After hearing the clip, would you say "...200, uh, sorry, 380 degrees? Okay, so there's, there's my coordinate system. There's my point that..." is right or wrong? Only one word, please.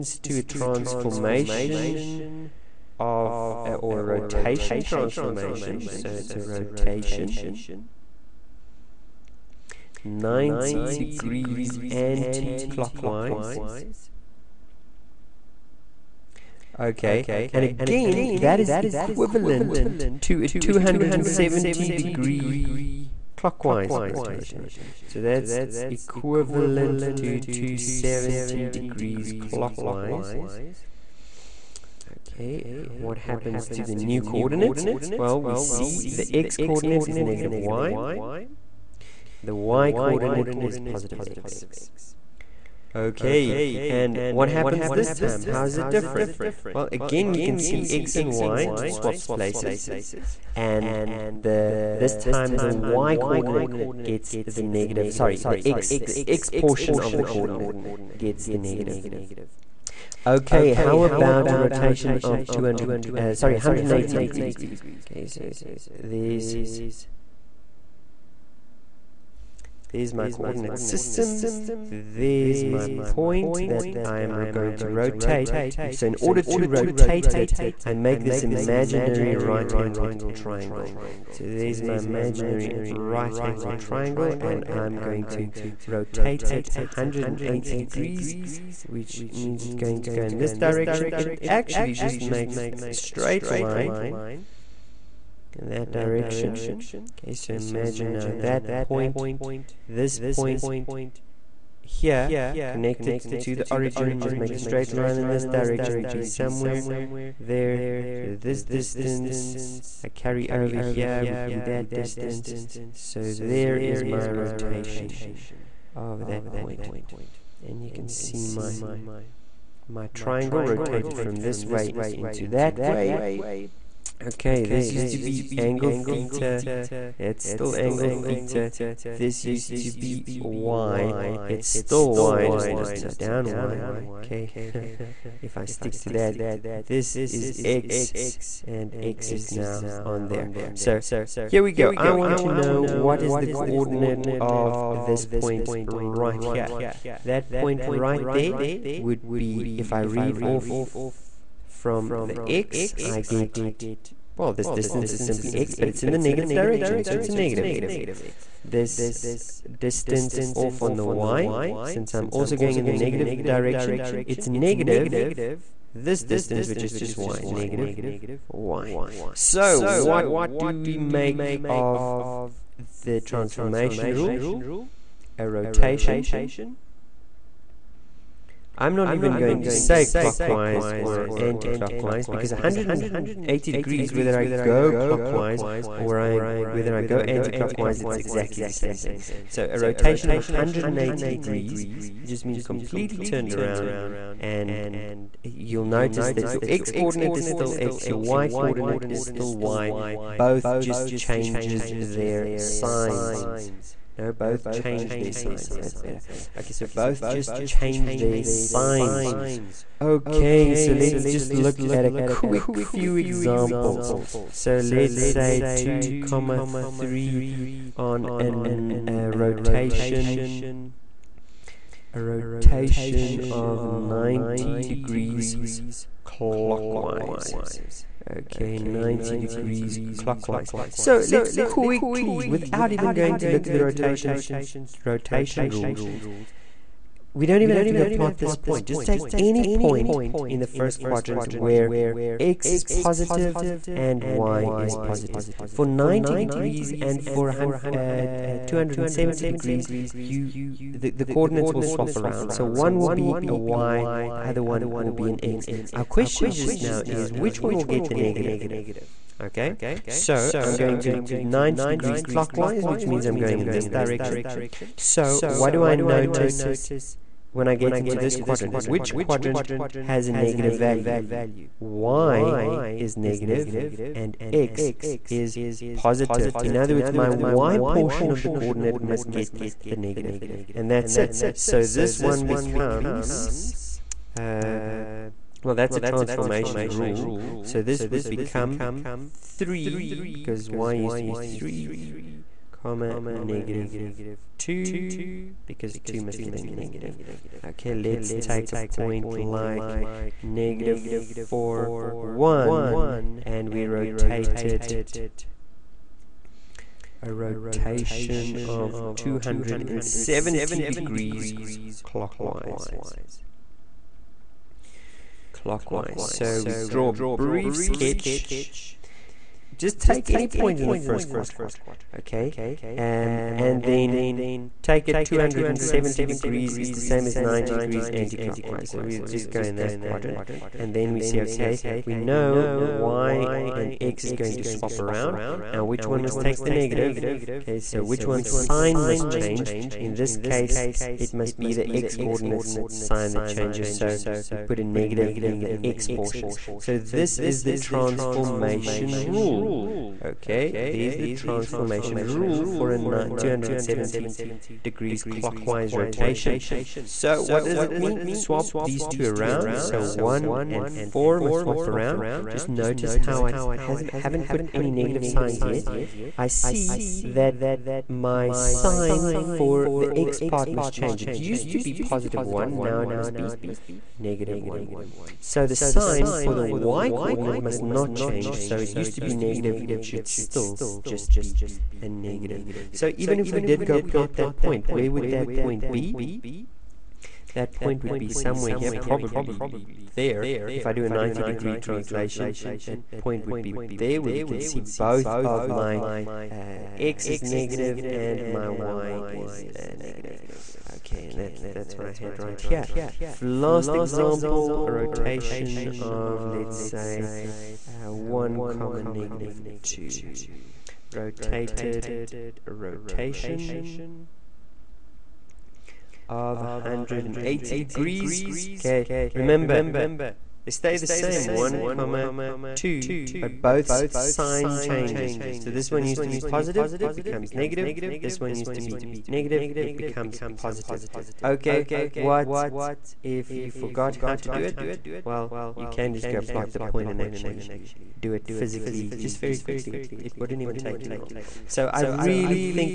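wrong.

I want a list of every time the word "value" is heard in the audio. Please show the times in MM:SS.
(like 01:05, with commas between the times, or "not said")
04:30.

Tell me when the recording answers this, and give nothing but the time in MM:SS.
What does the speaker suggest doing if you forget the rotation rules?
07:16.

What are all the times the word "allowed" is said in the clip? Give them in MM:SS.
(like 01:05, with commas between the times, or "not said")
not said.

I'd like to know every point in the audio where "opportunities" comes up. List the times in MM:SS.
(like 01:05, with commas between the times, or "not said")
not said.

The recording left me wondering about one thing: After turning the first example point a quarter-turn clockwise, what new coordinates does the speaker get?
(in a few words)
(3, -2).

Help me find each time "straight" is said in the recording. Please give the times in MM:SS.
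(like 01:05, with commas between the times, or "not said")
01:32, 01:44.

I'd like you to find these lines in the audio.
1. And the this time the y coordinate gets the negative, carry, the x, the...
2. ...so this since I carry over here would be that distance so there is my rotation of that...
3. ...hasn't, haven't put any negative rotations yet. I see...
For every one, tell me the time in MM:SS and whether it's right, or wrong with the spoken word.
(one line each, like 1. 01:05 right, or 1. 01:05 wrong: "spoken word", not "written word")
1. 00:50 wrong: "sorry", not "carry"
2. 01:48 wrong: "distance", not "since"
3. 06:03 wrong: "signs", not "rotations".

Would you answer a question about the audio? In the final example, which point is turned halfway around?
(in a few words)
(1, -2).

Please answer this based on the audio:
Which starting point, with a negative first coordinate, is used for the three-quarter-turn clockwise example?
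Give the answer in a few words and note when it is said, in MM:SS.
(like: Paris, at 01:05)
(-4, 1), at 05:00.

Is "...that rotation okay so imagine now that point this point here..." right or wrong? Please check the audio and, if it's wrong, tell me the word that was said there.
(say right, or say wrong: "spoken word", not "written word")
wrong: "direction", not "rotation".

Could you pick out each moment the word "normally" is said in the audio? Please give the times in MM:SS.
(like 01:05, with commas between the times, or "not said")
not said.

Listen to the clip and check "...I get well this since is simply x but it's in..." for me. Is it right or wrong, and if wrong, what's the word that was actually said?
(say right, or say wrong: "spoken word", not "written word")
wrong: "distance", not "since".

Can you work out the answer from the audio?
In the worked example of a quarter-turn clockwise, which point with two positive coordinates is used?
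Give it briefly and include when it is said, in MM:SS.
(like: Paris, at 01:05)
(2, 3), at 03:35.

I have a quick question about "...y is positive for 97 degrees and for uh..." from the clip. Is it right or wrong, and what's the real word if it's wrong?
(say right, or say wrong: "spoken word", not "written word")
wrong: "90", not "97".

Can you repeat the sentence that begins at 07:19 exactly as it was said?
It, it wouldn't even take you long.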